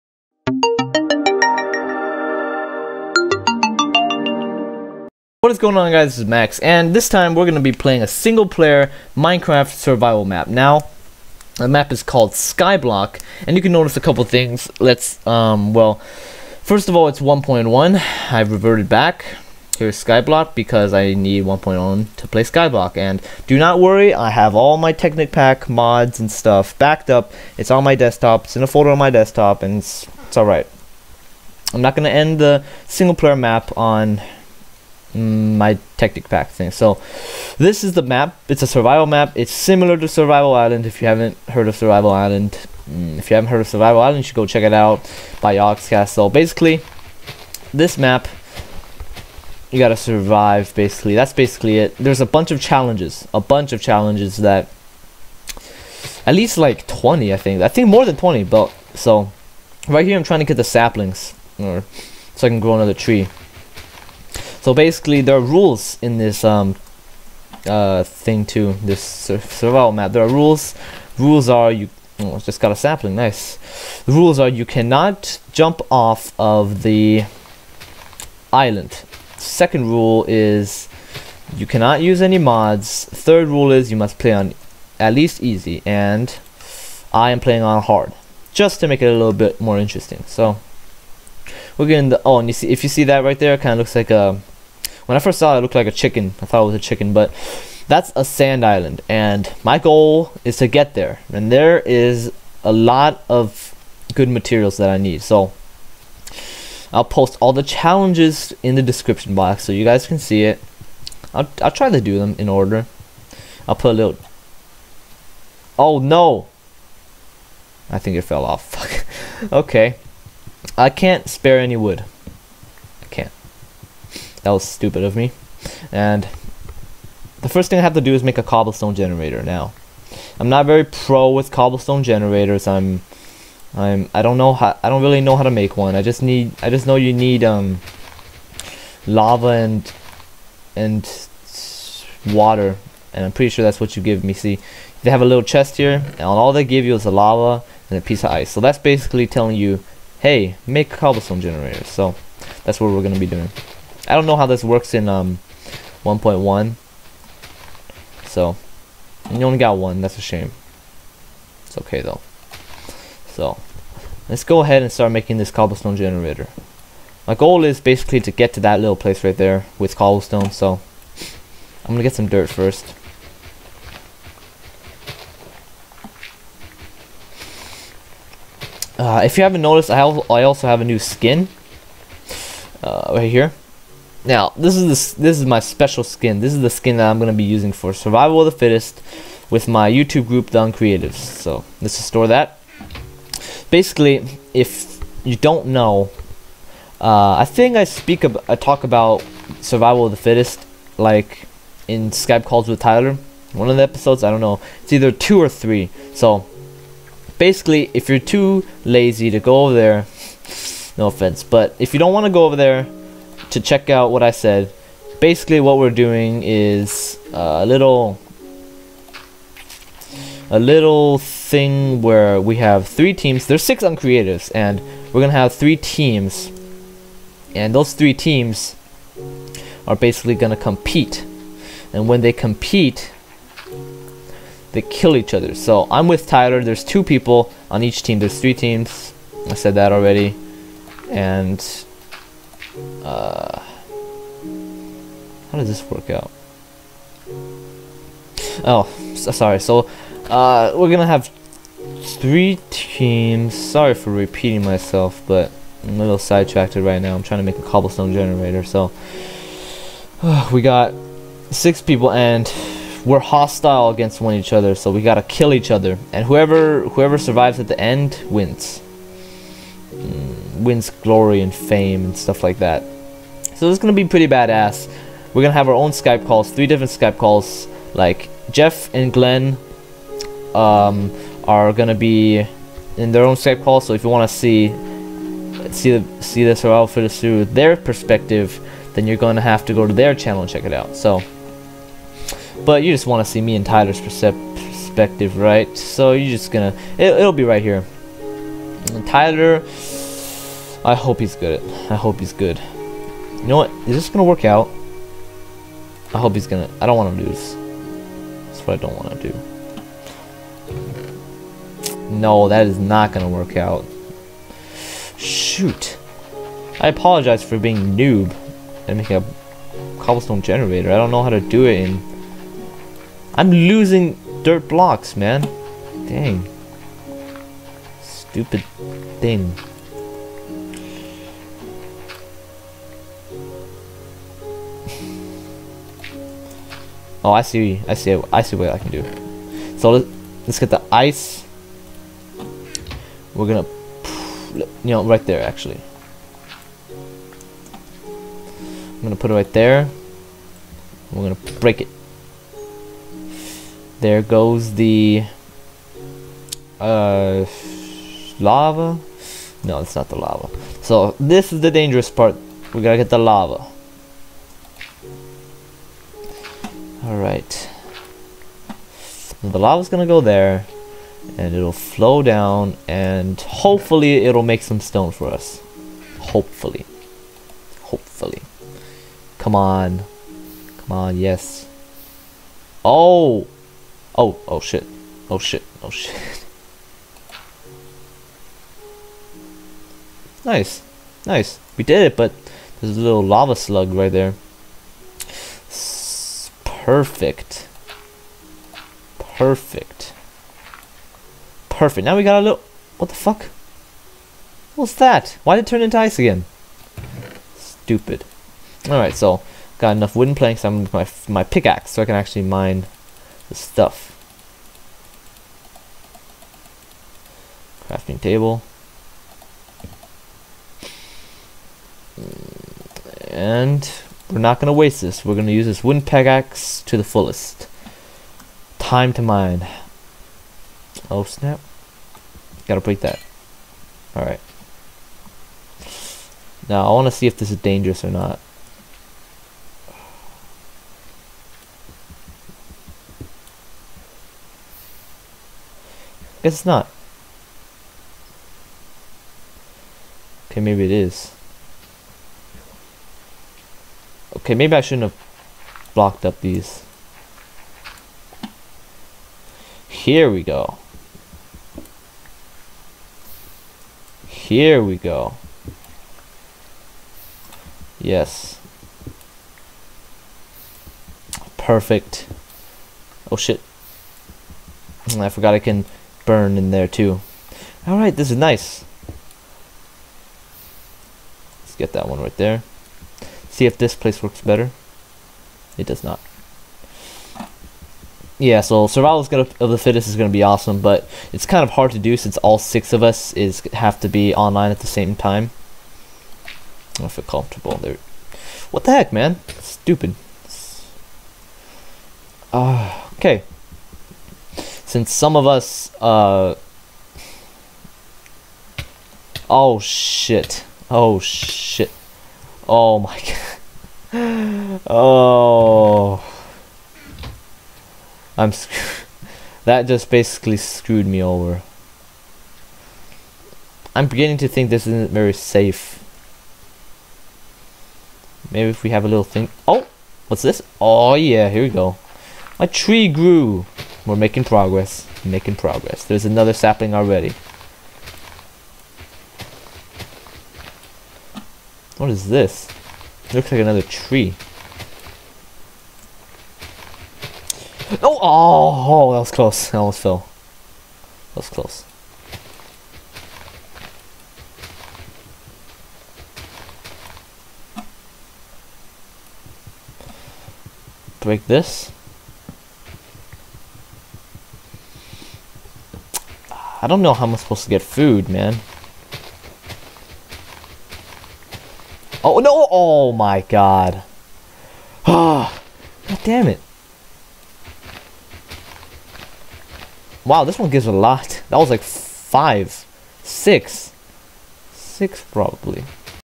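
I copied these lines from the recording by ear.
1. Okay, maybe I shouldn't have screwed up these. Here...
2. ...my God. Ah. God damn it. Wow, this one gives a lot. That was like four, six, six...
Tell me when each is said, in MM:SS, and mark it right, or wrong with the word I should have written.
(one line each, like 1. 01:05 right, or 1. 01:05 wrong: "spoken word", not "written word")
1. 07:34 wrong: "blocked", not "screwed"
2. 09:33 wrong: "five", not "four".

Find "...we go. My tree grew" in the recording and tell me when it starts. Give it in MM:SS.
08:51.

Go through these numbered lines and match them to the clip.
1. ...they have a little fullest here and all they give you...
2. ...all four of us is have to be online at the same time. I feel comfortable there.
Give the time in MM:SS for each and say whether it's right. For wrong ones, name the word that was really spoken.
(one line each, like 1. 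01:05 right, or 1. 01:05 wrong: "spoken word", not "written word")
1. 02:25 wrong: "chest", not "fullest"
2. 08:12 wrong: "six", not "four".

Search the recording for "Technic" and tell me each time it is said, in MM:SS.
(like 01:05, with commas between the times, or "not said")
00:24, 00:35.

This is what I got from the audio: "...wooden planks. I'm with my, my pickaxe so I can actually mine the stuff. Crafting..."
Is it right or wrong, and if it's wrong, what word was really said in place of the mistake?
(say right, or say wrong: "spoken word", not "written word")
right.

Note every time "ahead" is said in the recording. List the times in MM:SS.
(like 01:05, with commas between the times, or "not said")
02:44.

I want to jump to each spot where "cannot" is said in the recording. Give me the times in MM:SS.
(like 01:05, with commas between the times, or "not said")
01:14, 01:21.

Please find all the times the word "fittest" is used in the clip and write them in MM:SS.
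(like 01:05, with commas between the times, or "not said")
03:08, 03:20, 08:09.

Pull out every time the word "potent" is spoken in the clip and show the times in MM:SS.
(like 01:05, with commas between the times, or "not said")
not said.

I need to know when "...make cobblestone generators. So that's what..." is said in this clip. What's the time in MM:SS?
02:30.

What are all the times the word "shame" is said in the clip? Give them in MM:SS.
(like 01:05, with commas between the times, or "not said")
02:40.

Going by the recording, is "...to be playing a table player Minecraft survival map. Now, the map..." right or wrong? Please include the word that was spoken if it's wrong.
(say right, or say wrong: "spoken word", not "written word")
wrong: "single", not "table".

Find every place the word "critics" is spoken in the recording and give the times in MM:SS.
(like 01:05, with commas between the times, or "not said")
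not said.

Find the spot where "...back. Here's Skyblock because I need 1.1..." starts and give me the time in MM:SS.
00:18.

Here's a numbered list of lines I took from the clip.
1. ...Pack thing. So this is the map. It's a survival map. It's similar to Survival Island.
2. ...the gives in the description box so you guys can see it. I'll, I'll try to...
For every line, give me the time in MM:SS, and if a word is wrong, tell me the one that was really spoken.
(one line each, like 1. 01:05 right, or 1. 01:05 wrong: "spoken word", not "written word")
1. 00:36 right
2. 01:47 wrong: "challenges", not "gives".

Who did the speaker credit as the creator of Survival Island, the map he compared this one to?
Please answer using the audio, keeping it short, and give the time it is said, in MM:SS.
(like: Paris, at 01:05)
Ox Castle, at 00:45.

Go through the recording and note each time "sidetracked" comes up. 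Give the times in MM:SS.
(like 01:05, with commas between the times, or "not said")
04:16.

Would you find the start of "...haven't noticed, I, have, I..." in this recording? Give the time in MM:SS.
02:59.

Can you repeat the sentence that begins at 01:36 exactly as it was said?
I thought it was a chicken, but that's a sand island.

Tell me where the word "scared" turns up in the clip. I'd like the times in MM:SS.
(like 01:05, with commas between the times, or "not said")
not said.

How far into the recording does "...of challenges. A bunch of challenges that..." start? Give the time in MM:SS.
00:52.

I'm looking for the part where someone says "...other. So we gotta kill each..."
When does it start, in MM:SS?
04:24.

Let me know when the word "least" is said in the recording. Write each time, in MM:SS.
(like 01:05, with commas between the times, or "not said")
00:56, 01:25.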